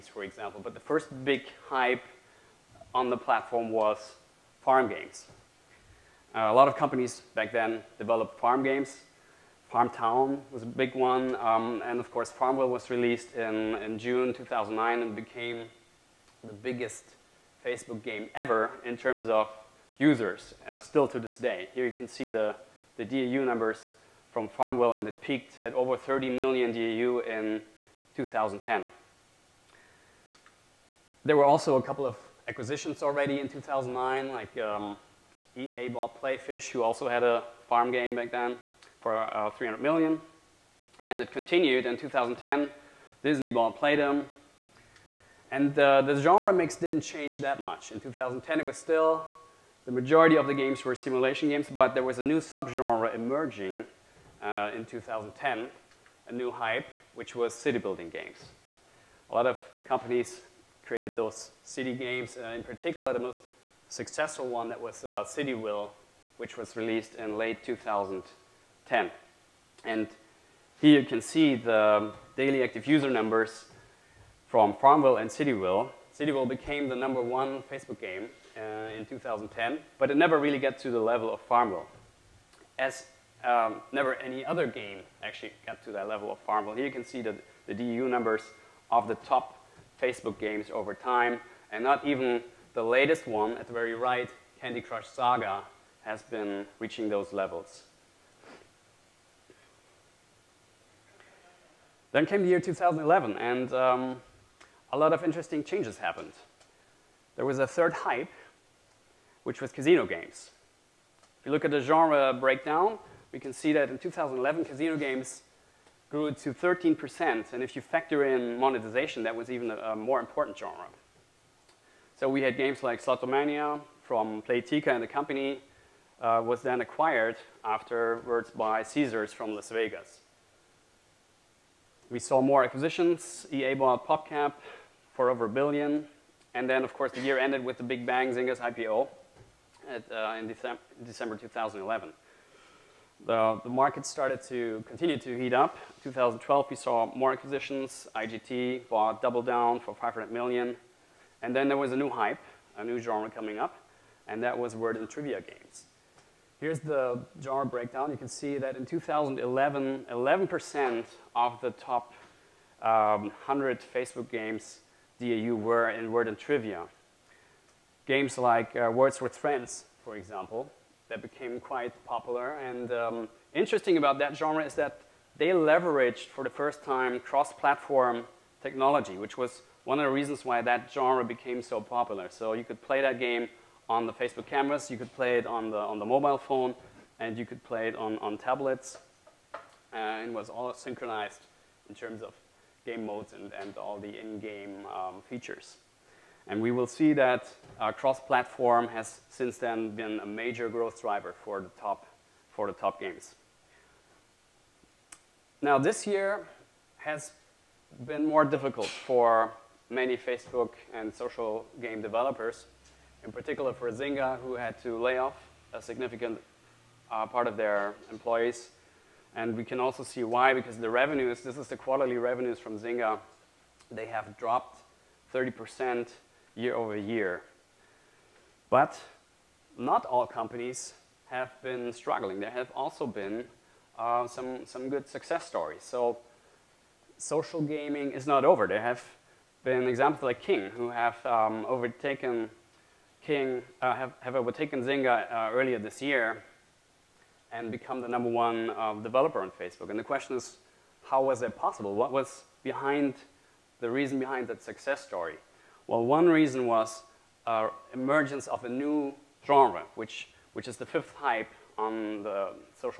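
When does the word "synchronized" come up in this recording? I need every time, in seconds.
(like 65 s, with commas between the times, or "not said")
190 s.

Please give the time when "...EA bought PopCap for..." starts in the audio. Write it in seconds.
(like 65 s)
133 s.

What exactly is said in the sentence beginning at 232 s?
There have also been uh, some, some good success stories.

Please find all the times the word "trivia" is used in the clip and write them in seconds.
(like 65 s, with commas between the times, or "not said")
155 s, 166 s.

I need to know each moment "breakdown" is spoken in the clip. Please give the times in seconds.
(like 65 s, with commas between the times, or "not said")
112 s, 157 s.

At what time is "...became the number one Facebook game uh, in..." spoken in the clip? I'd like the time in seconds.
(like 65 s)
76 s.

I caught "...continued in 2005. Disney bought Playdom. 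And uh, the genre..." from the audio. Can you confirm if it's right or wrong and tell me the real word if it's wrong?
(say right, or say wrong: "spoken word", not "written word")
wrong: "2010", not "2005".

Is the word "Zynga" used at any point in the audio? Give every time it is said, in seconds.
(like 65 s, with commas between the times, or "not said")
138 s, 213 s, 222 s, 244 s.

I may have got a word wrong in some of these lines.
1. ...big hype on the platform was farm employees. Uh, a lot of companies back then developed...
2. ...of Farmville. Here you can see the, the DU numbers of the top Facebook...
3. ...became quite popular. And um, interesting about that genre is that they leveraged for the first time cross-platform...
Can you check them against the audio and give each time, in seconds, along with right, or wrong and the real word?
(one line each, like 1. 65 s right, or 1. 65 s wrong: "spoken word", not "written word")
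1. 1 s wrong: "games", not "employees"
2. 86 s right
3. 171 s right.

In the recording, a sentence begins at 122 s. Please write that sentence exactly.
So we had games like Slotomania from Playtika and the company, uh, was then acquired afterwards by Caesars from Las Vegas.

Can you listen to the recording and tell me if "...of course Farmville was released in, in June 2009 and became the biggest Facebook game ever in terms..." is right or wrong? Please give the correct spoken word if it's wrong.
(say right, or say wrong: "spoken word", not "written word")
right.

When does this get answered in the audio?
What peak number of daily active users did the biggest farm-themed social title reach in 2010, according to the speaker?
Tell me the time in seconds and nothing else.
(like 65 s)
25 s.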